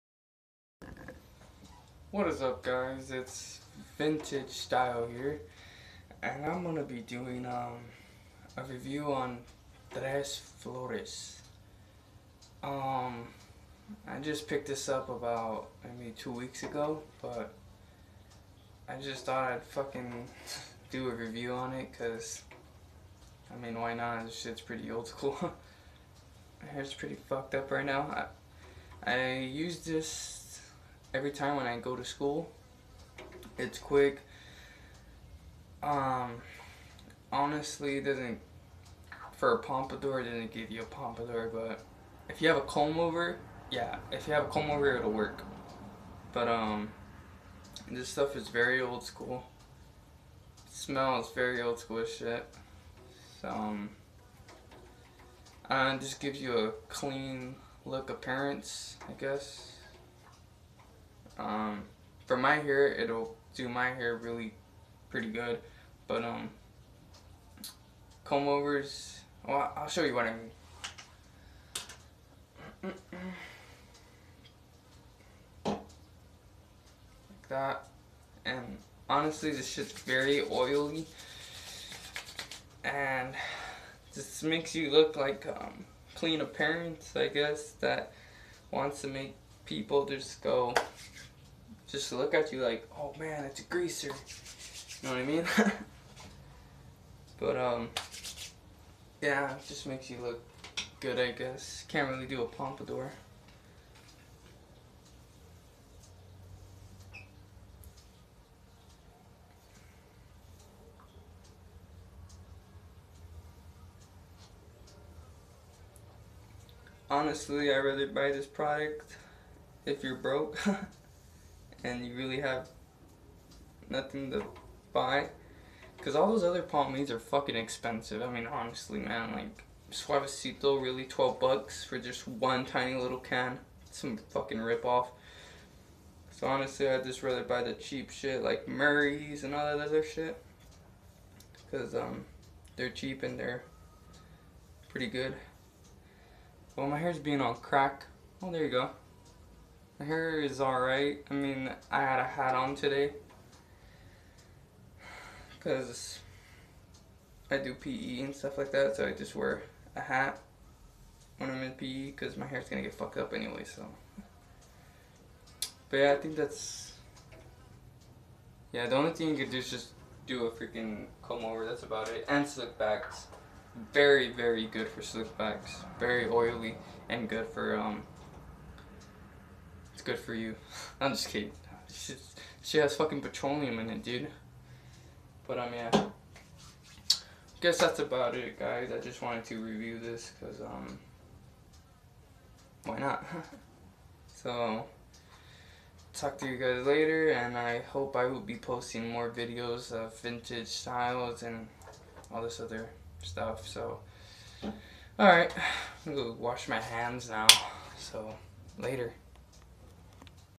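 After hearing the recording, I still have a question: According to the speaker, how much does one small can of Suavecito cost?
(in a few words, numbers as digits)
12 bucks.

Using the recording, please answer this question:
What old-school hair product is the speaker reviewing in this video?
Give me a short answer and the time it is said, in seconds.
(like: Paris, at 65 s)
Tres Flores, at 9 s.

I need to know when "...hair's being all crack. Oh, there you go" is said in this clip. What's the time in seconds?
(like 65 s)
146 s.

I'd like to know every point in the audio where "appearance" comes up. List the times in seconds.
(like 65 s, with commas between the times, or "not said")
58 s, 86 s.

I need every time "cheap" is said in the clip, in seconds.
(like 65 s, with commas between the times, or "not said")
137 s, 142 s.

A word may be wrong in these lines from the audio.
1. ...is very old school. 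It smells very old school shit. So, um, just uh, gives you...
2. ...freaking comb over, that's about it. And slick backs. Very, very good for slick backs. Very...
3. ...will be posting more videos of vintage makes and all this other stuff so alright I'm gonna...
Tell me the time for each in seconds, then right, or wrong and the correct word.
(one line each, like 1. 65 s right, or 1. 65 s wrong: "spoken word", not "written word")
1. 48 s right
2. 170 s right
3. 198 s wrong: "styles", not "makes".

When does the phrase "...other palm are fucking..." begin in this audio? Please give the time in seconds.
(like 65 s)
126 s.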